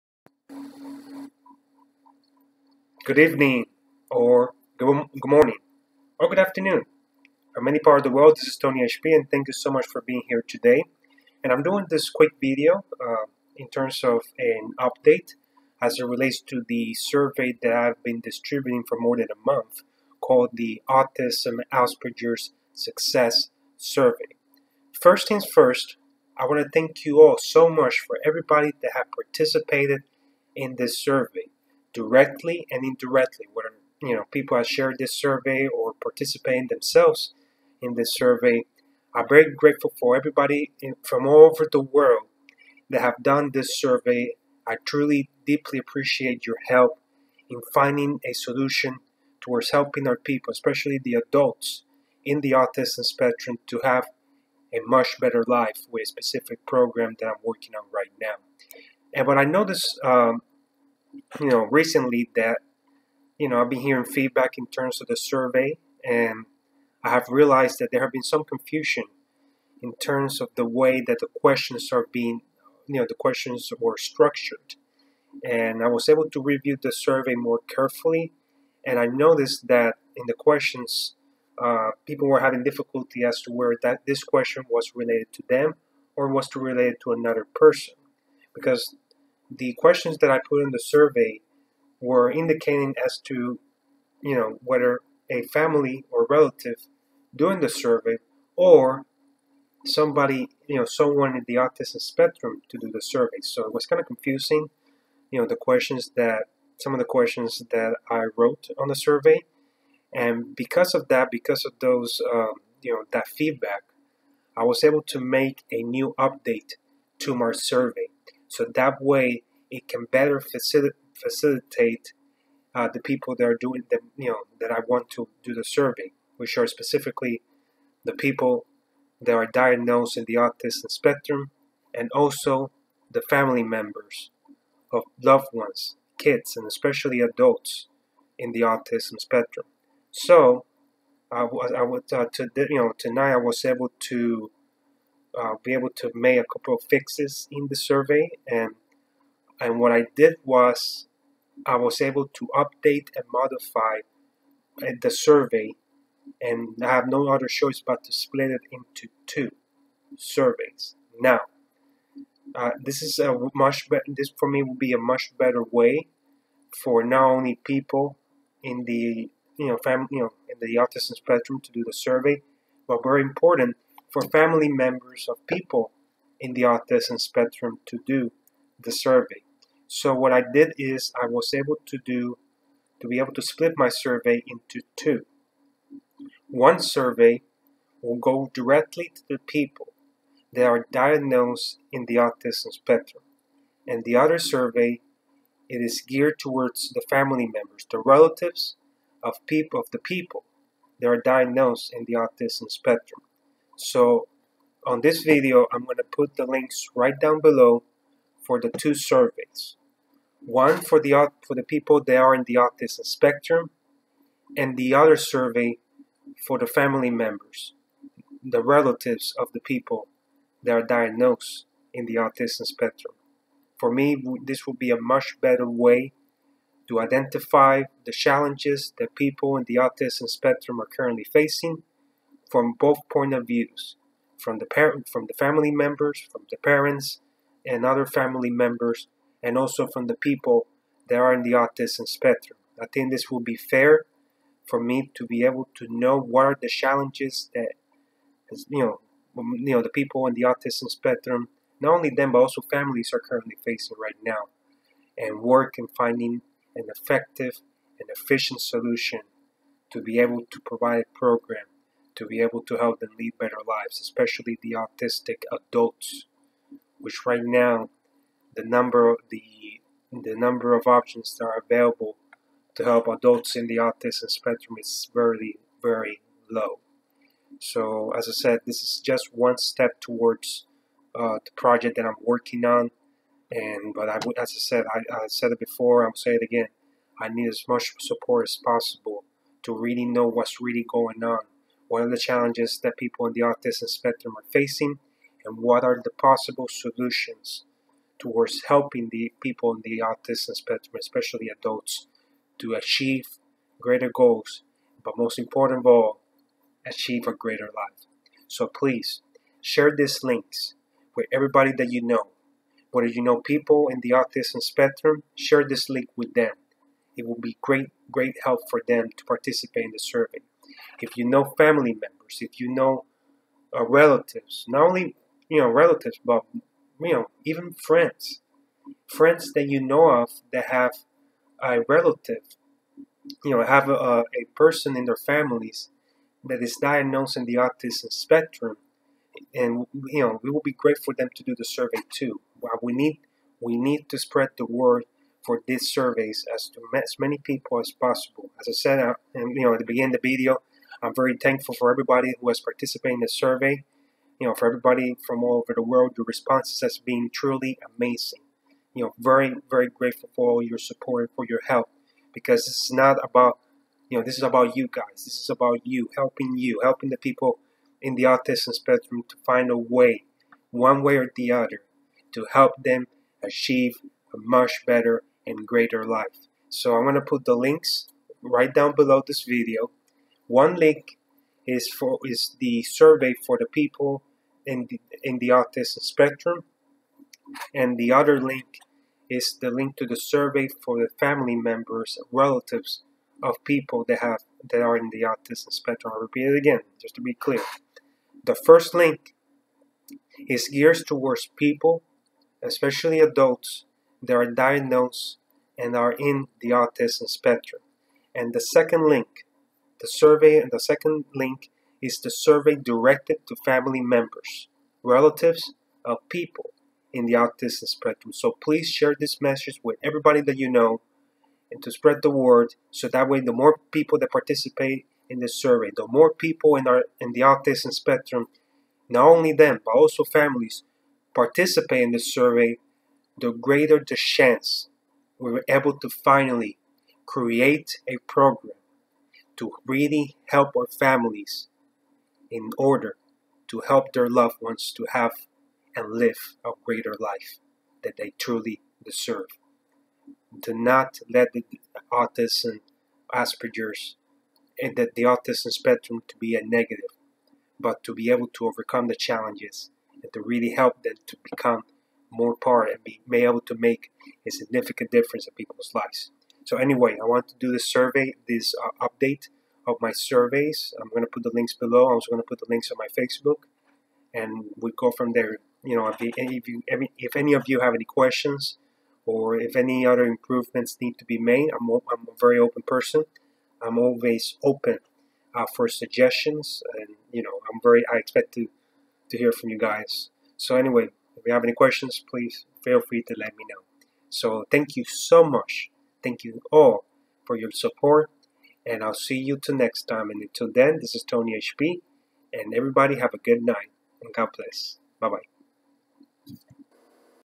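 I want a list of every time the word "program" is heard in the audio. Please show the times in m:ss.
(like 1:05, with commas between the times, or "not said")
0:56, 4:21, 7:18.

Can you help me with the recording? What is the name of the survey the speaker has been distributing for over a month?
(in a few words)
Autism Asperger's Success Survey.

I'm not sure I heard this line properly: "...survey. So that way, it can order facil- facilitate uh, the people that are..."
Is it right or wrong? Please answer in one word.
wrong.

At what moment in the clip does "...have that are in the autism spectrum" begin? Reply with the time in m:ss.
6:34.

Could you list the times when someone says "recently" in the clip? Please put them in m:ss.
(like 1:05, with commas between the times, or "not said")
1:01.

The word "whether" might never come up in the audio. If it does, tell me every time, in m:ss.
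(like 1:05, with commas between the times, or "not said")
1:34, 5:12.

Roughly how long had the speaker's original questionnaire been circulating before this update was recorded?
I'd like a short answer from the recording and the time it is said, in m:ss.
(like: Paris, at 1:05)
More than a month, at 0:18.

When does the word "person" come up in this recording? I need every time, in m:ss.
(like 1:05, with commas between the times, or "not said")
1:27, 5:34, 8:02.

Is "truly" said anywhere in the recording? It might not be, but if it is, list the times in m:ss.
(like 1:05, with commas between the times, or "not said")
0:44, 5:57, 7:28.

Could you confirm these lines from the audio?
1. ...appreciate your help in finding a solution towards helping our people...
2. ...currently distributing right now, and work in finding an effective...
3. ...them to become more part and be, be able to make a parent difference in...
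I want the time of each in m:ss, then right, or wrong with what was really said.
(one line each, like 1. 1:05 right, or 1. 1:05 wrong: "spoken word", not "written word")
1. 0:45 right
2. 4:13 wrong: "facing", not "distributing"
3. 7:41 wrong: "significant", not "parent".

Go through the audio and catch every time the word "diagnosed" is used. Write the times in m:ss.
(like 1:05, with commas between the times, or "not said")
2:09, 3:10, 3:21, 3:40, 5:36, 6:44.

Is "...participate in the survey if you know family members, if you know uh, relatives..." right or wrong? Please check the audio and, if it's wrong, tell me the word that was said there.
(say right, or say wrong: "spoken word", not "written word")
right.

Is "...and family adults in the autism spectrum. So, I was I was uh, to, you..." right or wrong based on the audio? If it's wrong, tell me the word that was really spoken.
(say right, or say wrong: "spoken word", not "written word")
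wrong: "especially", not "family".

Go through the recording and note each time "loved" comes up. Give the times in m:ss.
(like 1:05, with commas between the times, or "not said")
2:15, 7:24.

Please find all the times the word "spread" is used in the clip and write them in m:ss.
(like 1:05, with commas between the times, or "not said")
5:44, 7:01.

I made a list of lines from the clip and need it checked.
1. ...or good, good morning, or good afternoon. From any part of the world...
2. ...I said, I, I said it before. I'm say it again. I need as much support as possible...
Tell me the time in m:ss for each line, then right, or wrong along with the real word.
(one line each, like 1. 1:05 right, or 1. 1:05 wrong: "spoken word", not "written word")
1. 0:04 right
2. 4:44 right.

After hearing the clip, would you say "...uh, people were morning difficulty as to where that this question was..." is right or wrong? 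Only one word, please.
wrong.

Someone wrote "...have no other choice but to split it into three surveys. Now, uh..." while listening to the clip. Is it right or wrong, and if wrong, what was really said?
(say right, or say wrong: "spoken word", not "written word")
wrong: "two", not "three".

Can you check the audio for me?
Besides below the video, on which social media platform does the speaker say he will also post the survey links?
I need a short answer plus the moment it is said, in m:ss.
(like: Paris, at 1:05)
Facebook, at 7:53.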